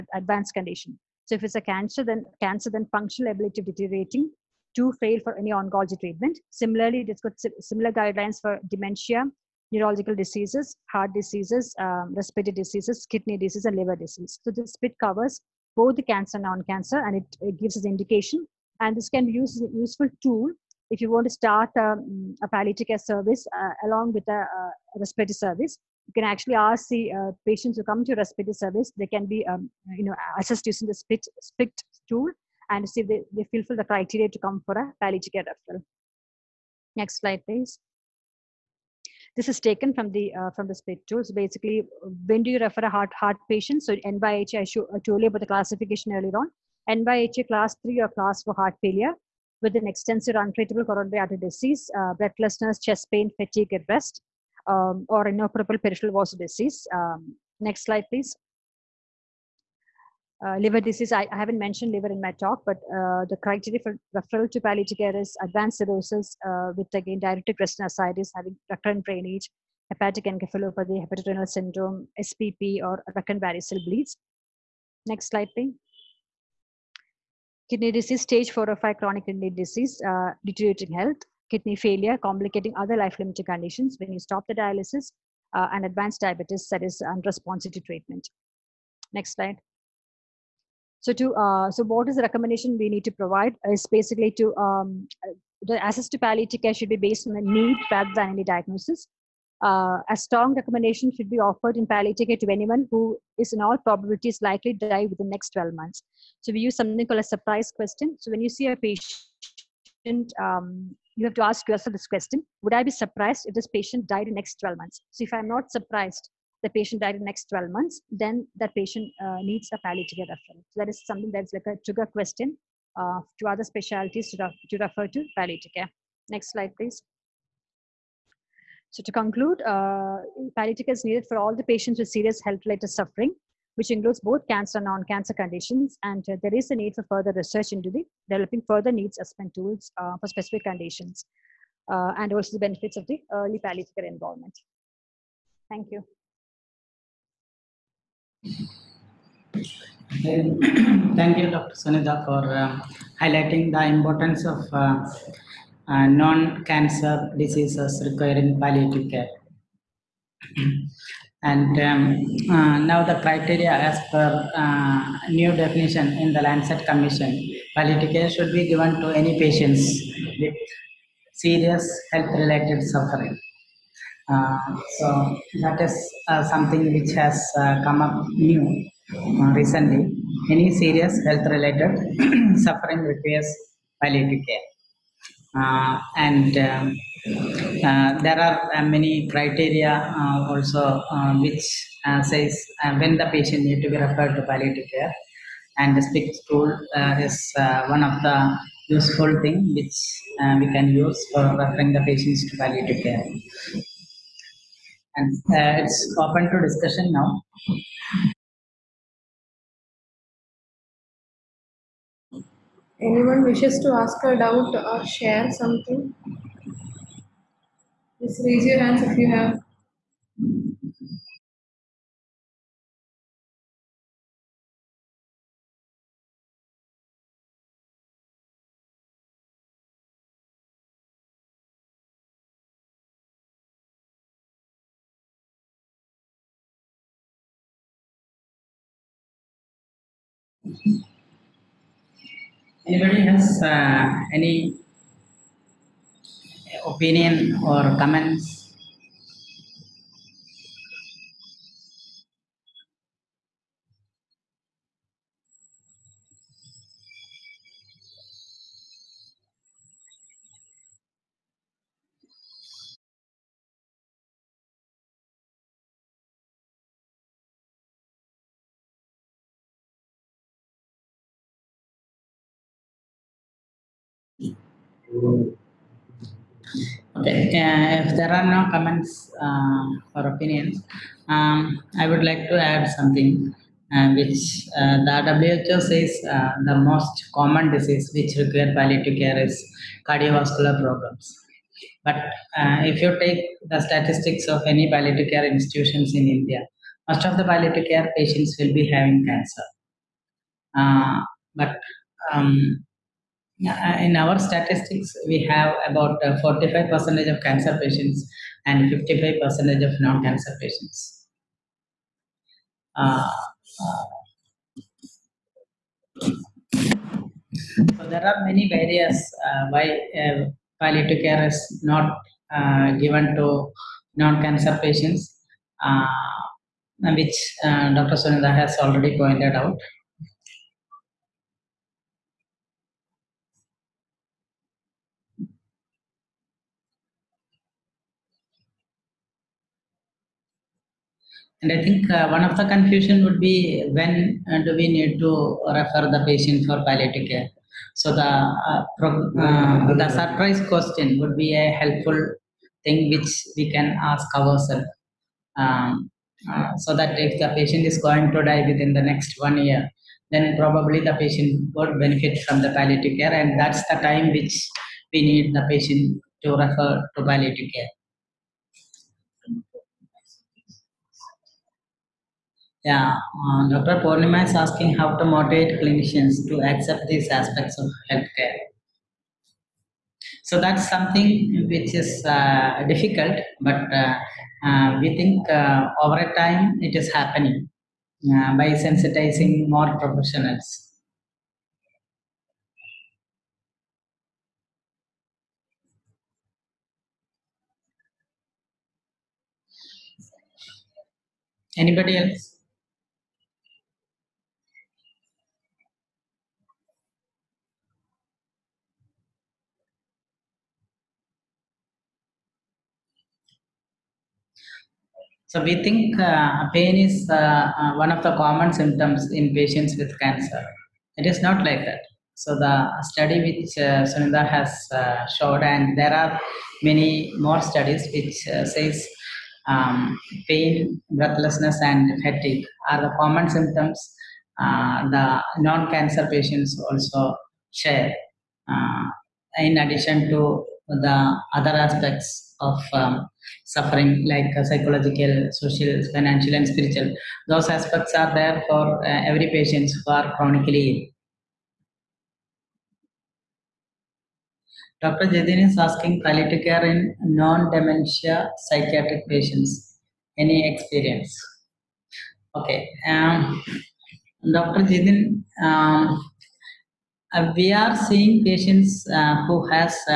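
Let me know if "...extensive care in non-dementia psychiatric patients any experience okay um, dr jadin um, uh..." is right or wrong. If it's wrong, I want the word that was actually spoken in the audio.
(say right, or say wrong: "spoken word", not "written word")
wrong: "palliative", not "extensive".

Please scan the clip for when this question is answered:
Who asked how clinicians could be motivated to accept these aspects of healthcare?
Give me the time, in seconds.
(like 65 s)
373 s.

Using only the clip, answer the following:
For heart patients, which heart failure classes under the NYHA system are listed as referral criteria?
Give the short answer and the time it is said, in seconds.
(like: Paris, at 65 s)
Class 3 or class 4, at 47 s.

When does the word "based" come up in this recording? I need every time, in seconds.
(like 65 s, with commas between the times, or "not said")
96 s.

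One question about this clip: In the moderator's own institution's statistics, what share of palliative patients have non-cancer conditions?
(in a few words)
55%.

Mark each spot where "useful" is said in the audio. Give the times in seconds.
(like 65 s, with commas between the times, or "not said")
19 s, 198 s.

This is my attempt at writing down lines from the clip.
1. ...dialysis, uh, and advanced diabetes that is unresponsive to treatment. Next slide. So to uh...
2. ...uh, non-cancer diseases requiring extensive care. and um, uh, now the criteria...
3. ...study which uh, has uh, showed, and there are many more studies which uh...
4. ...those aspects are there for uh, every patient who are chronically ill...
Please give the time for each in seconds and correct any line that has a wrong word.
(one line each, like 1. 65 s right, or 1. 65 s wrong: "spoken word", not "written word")
1. 84 s right
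2. 155 s wrong: "palliative", not "extensive"
3. 423 s right
4. 447 s right.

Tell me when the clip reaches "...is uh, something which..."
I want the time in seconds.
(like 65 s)
175 s.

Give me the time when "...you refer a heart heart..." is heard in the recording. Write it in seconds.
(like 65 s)
42 s.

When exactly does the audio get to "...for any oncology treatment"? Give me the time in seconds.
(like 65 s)
5 s.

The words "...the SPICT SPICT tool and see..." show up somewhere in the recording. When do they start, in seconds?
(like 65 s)
30 s.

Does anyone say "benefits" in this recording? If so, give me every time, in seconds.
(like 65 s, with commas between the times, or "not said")
142 s, 362 s.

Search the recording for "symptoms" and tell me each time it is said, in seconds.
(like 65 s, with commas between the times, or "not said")
418 s, 433 s.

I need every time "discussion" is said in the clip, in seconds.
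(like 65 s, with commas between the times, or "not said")
206 s.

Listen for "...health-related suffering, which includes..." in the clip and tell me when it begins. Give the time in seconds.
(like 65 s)
132 s.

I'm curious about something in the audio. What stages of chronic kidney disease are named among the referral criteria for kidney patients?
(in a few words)
Stage 4 or 5.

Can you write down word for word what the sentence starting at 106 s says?
So we use something called a surprise question.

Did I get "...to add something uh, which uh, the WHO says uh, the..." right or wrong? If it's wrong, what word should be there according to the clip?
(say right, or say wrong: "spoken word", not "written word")
right.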